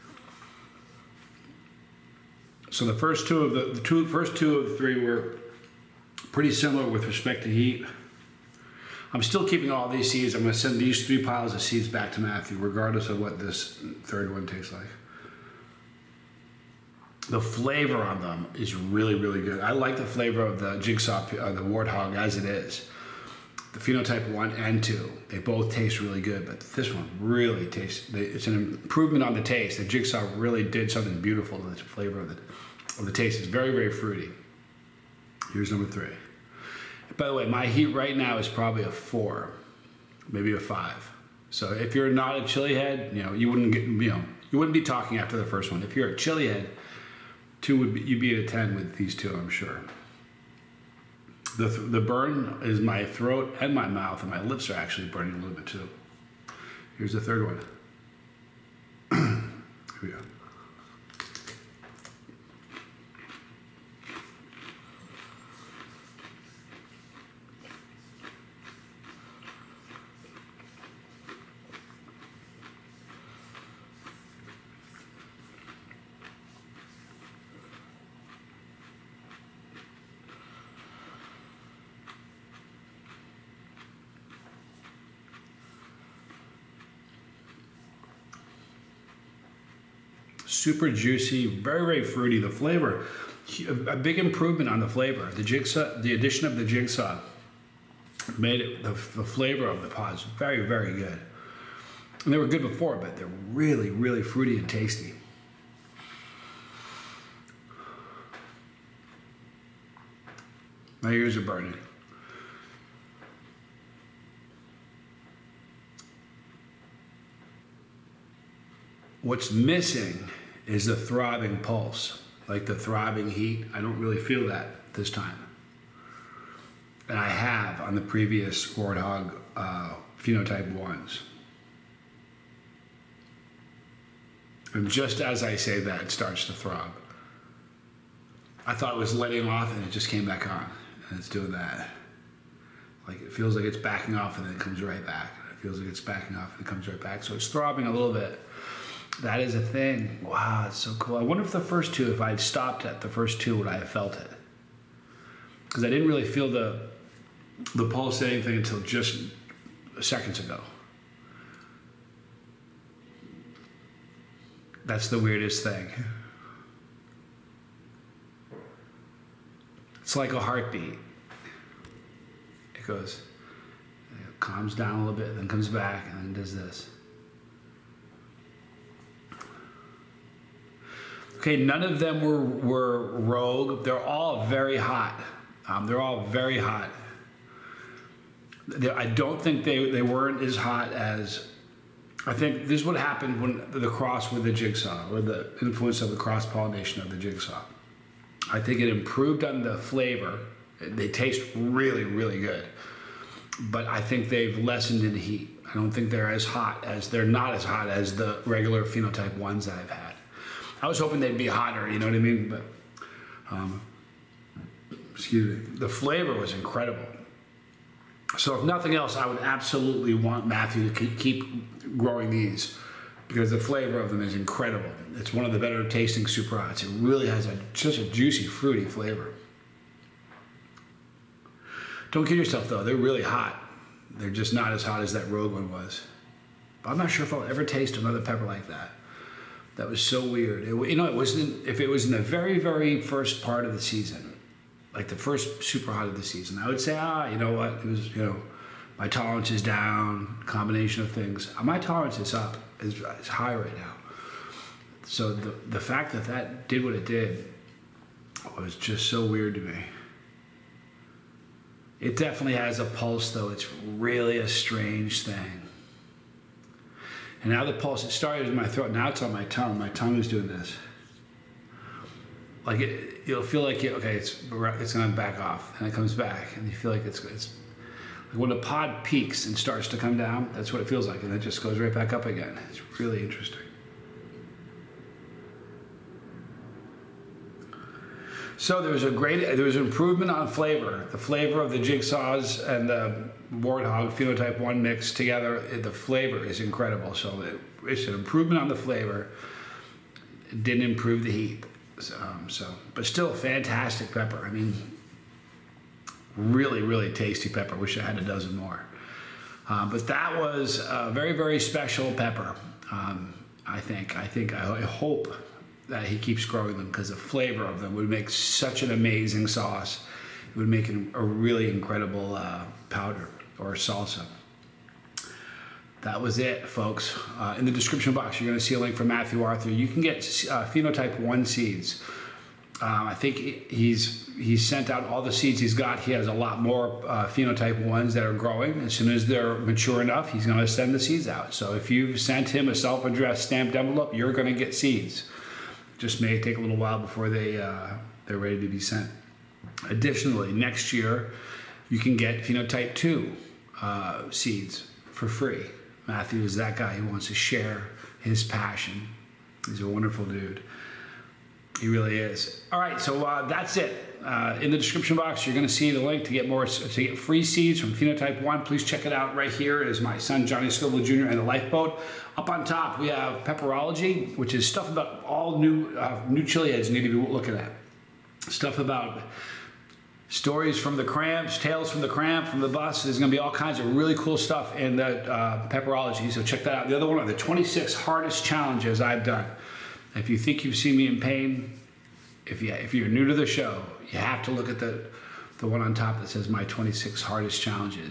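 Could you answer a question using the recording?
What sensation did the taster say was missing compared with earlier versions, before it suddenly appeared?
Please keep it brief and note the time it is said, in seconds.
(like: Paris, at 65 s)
throbbing pulse, at 120 s.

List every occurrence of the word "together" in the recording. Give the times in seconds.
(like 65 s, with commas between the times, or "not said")
295 s.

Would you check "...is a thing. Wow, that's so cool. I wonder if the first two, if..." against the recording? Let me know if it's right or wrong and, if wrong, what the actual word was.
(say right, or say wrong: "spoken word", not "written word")
right.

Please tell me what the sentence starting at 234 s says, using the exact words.
They're just not as hot as that Rogue one was.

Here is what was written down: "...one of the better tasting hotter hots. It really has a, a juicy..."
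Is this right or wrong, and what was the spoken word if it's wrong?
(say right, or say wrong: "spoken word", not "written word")
wrong: "super", not "hotter".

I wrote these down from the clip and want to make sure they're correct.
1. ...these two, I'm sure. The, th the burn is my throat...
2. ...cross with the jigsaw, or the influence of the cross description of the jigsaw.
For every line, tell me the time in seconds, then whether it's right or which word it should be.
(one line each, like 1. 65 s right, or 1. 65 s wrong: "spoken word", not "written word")
1. 48 s right
2. 193 s wrong: "pollination", not "description".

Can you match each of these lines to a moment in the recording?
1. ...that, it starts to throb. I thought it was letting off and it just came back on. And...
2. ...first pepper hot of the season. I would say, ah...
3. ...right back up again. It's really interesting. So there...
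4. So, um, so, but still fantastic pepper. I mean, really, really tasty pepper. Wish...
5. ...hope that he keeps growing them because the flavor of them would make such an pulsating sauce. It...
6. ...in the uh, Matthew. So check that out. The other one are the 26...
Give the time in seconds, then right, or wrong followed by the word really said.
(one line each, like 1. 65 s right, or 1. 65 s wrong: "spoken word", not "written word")
1. 135 s right
2. 245 s wrong: "super", not "pepper"
3. 281 s right
4. 301 s right
5. 314 s wrong: "amazing", not "pulsating"
6. 384 s wrong: "Pepperology", not "Matthew".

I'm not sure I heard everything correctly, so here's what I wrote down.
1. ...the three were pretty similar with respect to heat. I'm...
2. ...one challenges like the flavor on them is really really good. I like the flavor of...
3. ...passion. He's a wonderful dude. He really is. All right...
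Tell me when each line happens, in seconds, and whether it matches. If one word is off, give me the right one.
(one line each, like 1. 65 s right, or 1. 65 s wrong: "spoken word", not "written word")
1. 4 s right
2. 14 s wrong: "tastes", not "challenges"
3. 358 s right.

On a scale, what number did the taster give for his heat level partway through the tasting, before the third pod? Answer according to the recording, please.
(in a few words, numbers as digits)
4.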